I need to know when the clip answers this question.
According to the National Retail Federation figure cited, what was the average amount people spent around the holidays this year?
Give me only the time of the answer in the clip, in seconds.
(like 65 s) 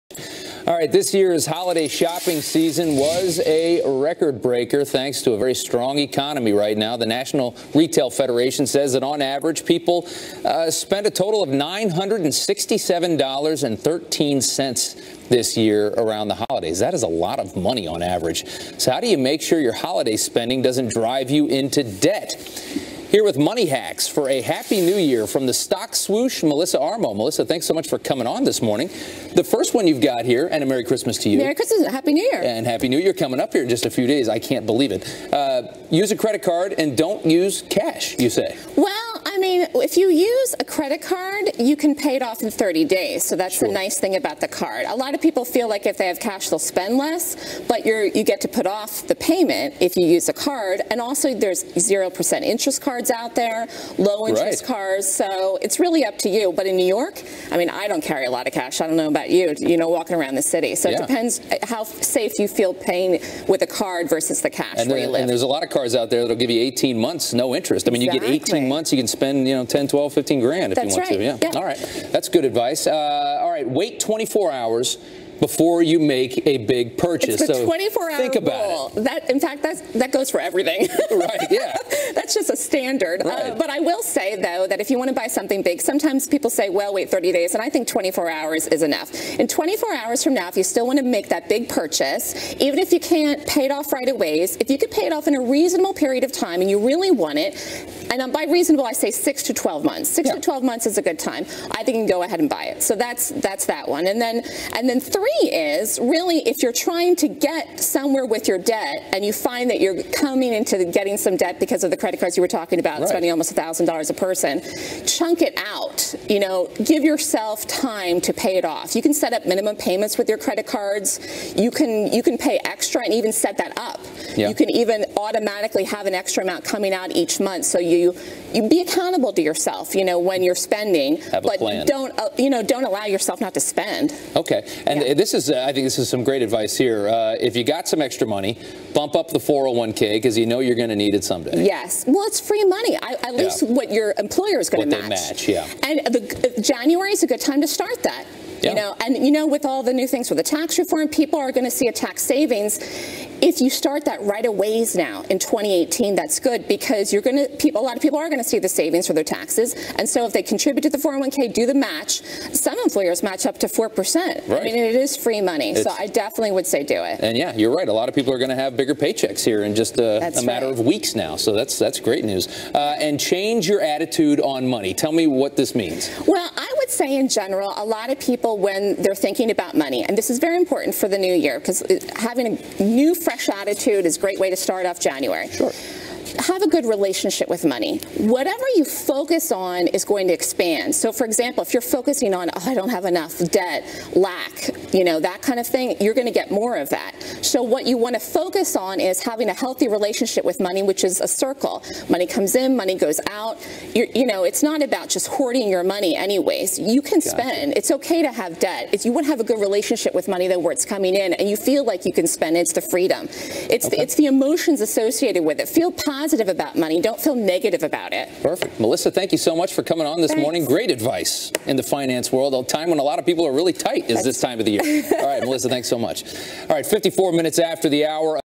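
11 s.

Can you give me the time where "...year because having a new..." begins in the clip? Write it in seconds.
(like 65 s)
181 s.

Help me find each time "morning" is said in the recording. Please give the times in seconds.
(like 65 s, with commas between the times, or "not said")
28 s, 220 s.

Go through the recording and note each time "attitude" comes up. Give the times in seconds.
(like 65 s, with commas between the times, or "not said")
173 s, 183 s.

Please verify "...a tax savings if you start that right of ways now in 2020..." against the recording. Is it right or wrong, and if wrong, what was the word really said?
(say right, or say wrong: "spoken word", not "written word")
wrong: "2018", not "2020".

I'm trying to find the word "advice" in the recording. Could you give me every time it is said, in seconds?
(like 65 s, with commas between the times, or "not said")
72 s, 136 s, 220 s.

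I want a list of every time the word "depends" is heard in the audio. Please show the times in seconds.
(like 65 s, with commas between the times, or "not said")
61 s.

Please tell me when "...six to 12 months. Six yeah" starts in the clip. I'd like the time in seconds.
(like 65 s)
99 s.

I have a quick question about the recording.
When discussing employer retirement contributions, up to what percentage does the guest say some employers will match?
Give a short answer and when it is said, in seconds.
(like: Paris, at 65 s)
4%, at 163 s.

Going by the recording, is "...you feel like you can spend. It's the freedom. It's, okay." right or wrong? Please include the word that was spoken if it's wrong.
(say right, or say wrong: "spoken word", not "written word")
right.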